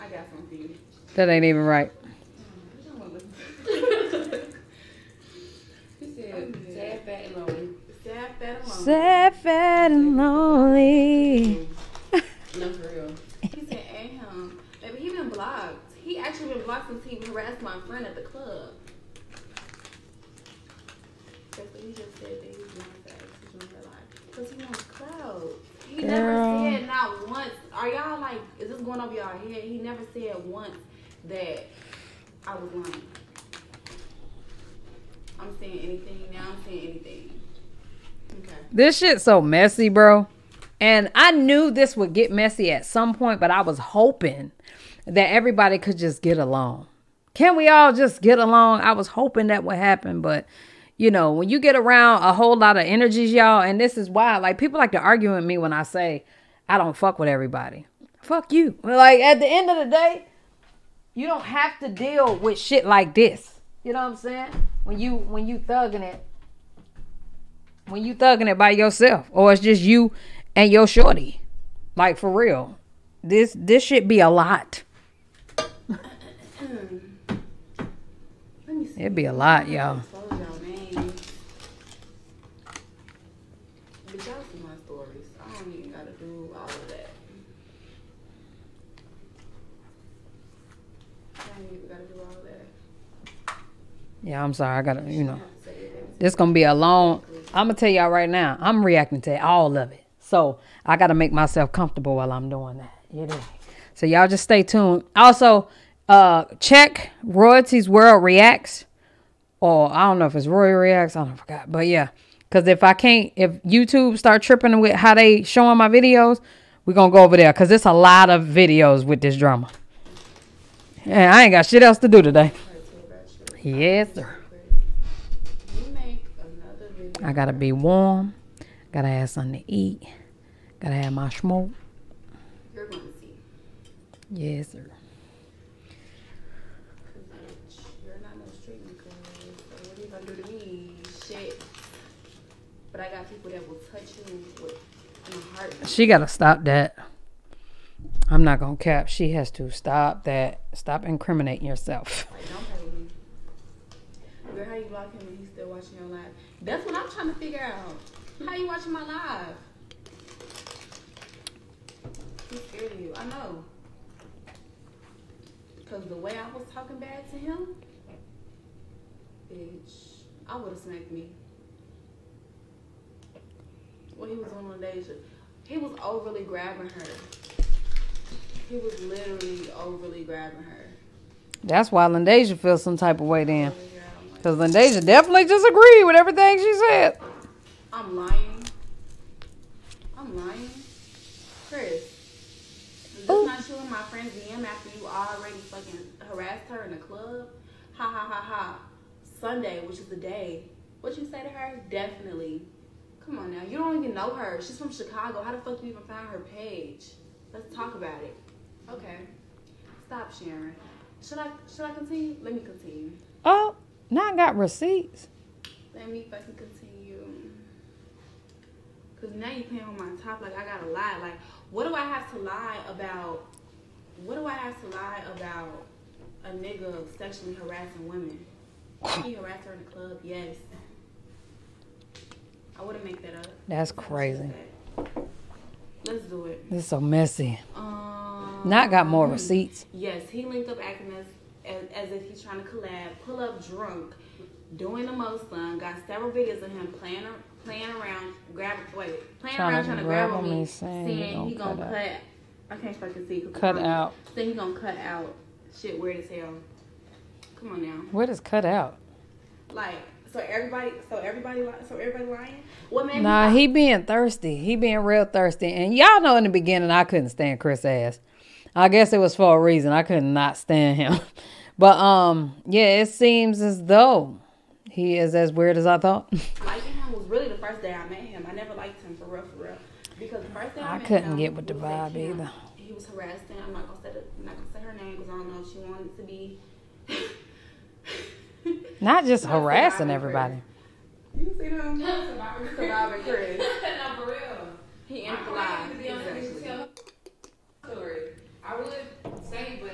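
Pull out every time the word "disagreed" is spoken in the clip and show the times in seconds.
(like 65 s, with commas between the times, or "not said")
185 s.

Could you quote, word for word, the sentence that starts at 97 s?
I'm gonna tell y'all right now, I'm reacting to all of it.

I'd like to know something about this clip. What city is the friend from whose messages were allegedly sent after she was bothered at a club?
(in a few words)
Chicago.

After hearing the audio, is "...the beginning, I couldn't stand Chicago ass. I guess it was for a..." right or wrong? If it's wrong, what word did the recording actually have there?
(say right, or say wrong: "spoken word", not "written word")
wrong: "Chris", not "Chicago".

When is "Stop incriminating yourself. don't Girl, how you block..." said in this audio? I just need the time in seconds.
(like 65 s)
150 s.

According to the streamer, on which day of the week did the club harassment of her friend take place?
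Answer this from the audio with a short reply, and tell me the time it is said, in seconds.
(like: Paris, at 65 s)
Sunday, at 199 s.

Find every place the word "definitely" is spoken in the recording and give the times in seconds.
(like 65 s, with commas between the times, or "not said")
185 s, 201 s.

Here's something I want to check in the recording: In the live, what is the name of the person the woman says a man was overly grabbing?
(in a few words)
Deja.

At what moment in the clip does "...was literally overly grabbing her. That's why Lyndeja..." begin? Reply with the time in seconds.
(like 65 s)
178 s.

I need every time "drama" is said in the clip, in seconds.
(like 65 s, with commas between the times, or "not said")
119 s.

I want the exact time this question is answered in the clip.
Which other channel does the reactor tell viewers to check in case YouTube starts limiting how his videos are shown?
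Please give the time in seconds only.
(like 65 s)
107 s.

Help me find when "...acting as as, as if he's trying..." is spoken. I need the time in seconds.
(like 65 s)
240 s.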